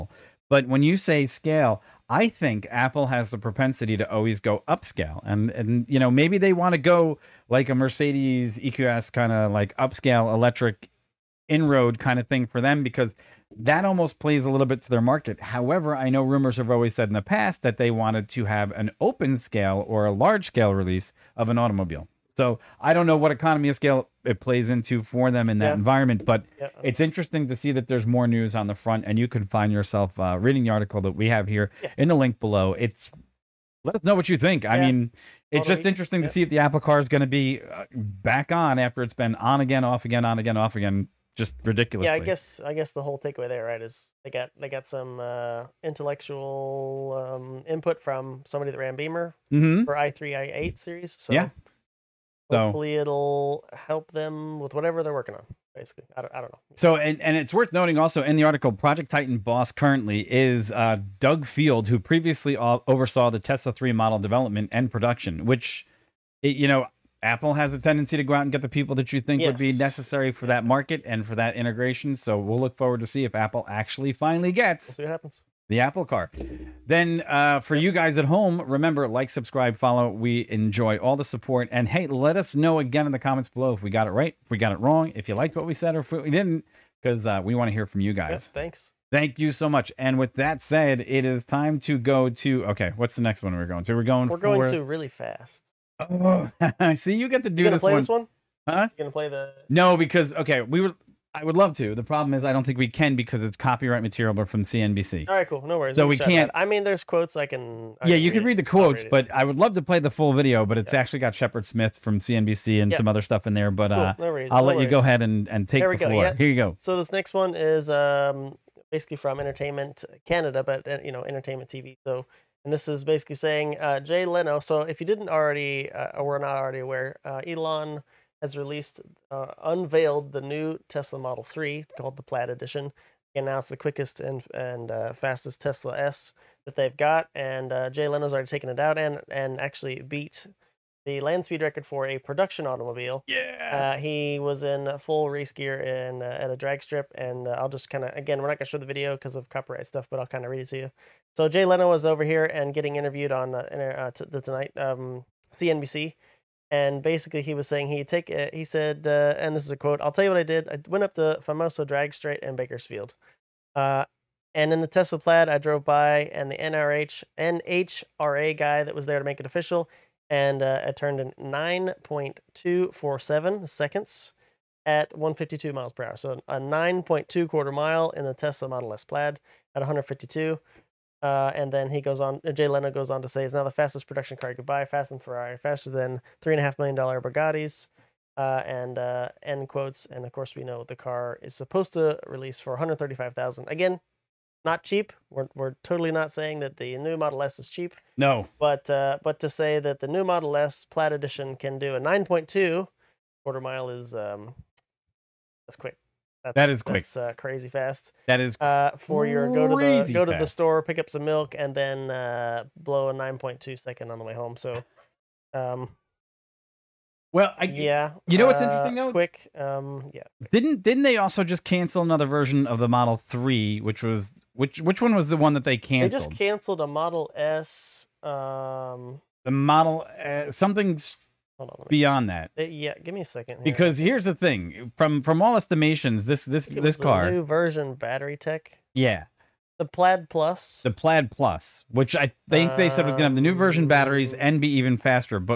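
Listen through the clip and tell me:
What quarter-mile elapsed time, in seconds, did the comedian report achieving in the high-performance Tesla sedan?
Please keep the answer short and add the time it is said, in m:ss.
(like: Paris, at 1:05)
9.247 seconds, at 2:51.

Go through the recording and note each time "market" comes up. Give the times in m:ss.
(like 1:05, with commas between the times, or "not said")
0:15, 1:10.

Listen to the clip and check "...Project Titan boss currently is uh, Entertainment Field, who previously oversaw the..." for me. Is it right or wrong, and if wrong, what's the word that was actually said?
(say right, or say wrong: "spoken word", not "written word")
wrong: "Doug", not "Entertainment".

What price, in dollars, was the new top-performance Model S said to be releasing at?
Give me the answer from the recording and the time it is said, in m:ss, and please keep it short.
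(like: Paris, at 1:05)
$135,000, at 3:12.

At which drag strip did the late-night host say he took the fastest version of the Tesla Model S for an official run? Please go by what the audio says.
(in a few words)
Famoso.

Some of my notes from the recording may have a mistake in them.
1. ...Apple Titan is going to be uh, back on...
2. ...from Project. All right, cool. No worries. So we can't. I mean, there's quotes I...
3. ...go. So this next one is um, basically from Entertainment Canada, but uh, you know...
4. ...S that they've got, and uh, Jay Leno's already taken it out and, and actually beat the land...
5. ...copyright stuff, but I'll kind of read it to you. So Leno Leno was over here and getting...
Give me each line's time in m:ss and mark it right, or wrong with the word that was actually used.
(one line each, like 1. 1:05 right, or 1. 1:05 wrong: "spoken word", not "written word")
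1. 0:36 wrong: "Car", not "Titan"
2. 1:44 wrong: "CNBC", not "Project"
3. 1:56 right
4. 2:15 right
5. 2:29 wrong: "Jay", not "Leno".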